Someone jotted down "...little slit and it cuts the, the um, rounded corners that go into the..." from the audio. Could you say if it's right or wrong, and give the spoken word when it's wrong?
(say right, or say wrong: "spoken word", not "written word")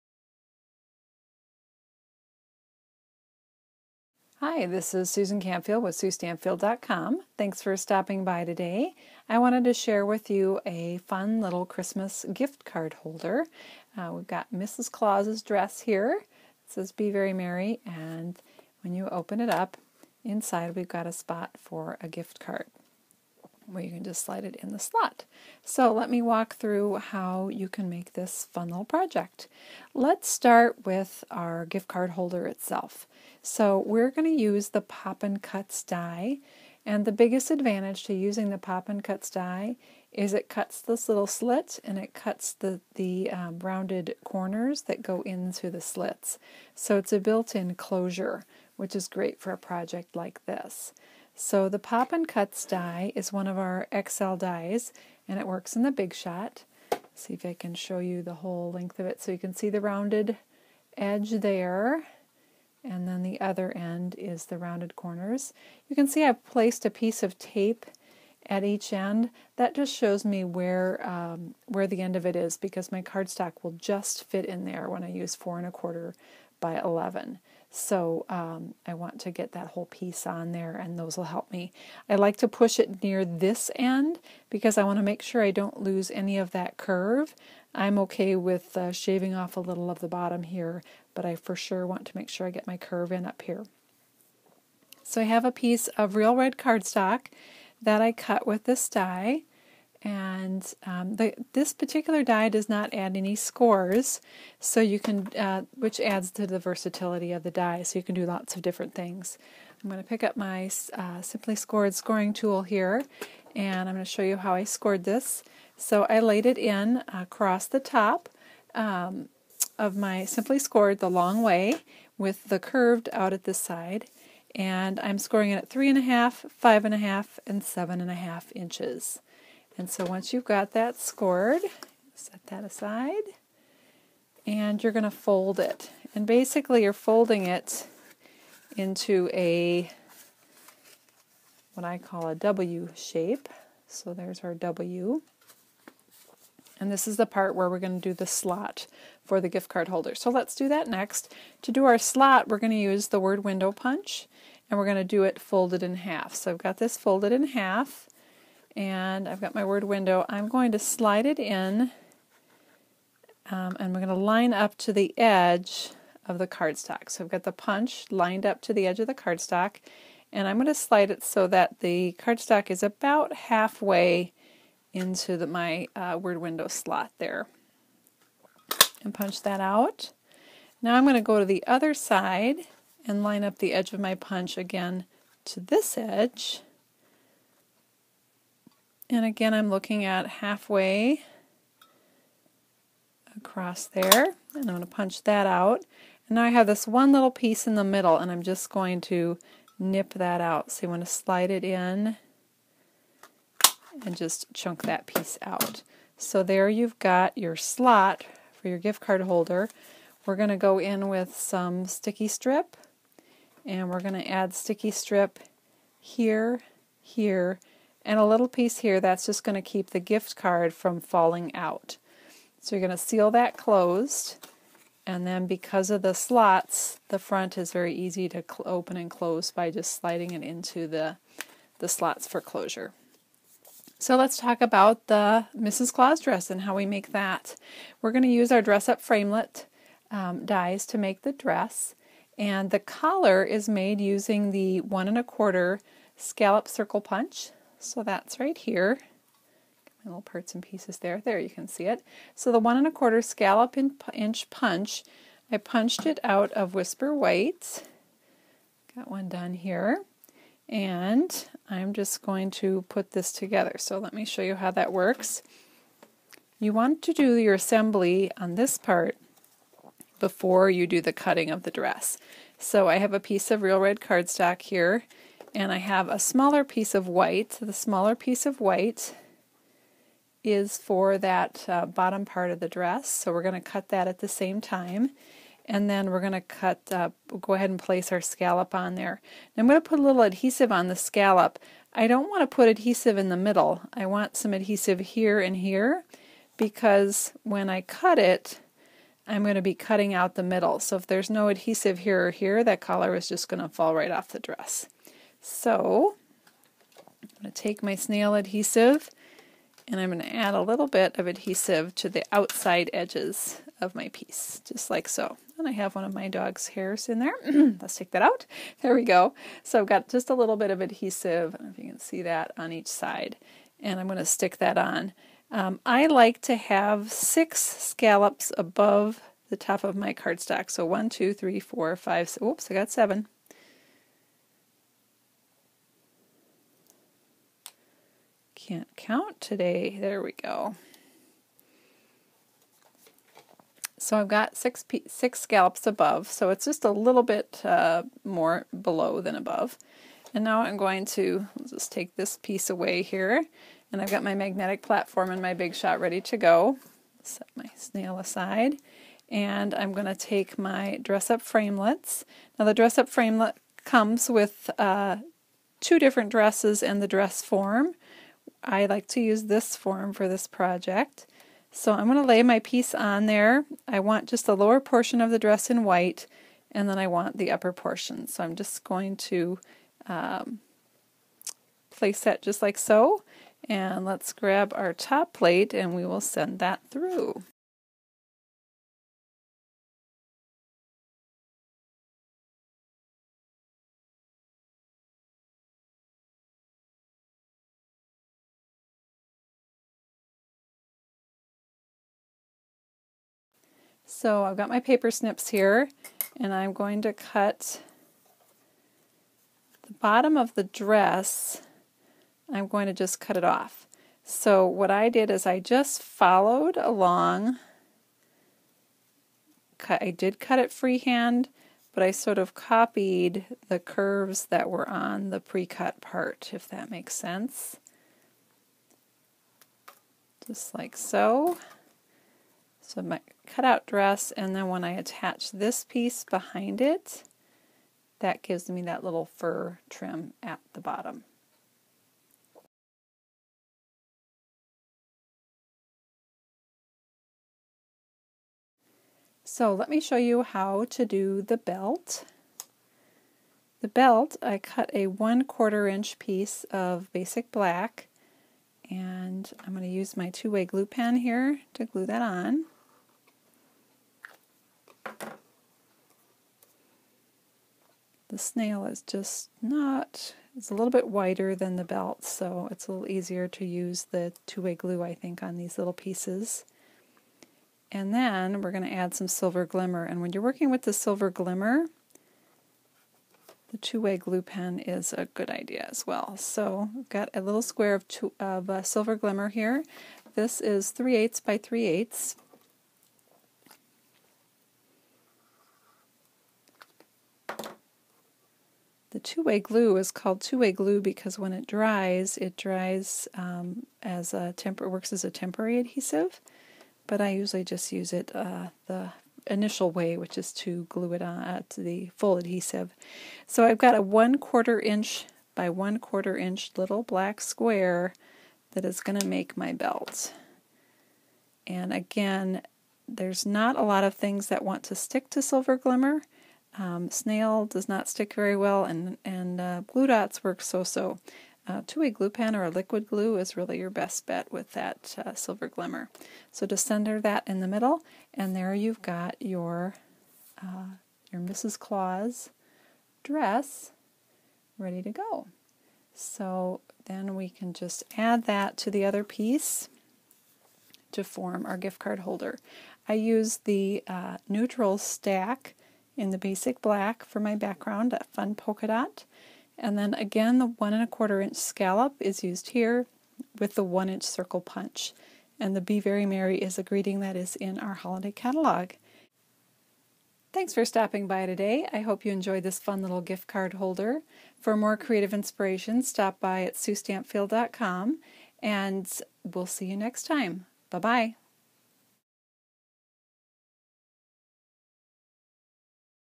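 right.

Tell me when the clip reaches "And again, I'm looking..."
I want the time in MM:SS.
03:09.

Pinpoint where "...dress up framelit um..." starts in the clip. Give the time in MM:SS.
03:58.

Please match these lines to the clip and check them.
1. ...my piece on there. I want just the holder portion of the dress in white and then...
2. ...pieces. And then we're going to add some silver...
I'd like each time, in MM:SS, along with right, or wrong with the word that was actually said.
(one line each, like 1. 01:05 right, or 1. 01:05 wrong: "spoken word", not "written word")
1. 06:12 wrong: "lower", not "holder"
2. 07:55 right.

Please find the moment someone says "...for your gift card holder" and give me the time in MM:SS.
03:28.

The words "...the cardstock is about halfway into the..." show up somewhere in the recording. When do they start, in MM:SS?
02:51.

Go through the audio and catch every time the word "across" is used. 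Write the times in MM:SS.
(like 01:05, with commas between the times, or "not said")
01:57, 03:13.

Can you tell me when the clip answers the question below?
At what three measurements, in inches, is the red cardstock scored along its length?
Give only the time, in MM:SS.
02:05.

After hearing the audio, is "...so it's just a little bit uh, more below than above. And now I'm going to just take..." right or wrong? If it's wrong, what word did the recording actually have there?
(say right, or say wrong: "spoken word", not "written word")
right.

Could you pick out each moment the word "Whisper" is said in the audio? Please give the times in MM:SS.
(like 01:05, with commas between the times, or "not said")
04:16.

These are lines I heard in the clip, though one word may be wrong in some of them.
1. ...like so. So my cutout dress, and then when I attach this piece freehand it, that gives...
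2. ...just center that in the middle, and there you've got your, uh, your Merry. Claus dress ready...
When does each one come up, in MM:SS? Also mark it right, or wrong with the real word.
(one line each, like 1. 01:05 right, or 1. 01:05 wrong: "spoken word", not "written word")
1. 07:10 wrong: "behind", not "freehand"
2. 08:56 wrong: "Mrs", not "Merry".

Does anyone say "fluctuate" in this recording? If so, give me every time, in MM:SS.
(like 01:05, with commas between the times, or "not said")
not said.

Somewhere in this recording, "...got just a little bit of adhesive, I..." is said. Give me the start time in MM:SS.
05:19.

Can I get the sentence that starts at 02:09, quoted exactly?
And so once you've got that scored, set that aside, and you're going to fold it.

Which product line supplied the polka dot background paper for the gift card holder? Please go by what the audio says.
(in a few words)
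neutral stack.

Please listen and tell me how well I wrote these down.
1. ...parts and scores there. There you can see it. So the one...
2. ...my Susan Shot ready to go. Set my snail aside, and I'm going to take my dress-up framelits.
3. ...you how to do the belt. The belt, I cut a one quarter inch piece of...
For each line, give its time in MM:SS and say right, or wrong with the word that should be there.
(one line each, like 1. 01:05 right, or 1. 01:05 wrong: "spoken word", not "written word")
1. 04:10 wrong: "pieces", not "scores"
2. 05:55 wrong: "Big", not "Susan"
3. 07:30 right.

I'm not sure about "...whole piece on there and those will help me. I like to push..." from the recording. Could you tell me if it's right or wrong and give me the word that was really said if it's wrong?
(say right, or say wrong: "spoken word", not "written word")
right.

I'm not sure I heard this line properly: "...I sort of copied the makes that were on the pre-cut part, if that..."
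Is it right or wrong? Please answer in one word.
wrong.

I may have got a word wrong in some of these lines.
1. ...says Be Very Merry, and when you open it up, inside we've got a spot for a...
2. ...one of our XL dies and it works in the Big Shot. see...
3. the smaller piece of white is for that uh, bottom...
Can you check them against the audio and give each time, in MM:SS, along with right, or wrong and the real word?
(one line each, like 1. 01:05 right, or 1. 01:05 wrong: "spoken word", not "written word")
1. 00:16 right
2. 00:53 right
3. 04:37 right.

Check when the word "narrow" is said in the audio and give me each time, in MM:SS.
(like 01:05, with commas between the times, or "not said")
not said.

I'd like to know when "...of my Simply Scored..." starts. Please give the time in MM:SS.
01:59.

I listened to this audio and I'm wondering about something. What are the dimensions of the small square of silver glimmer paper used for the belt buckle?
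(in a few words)
3/8 by 3/8 inch.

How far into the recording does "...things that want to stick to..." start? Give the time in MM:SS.
08:44.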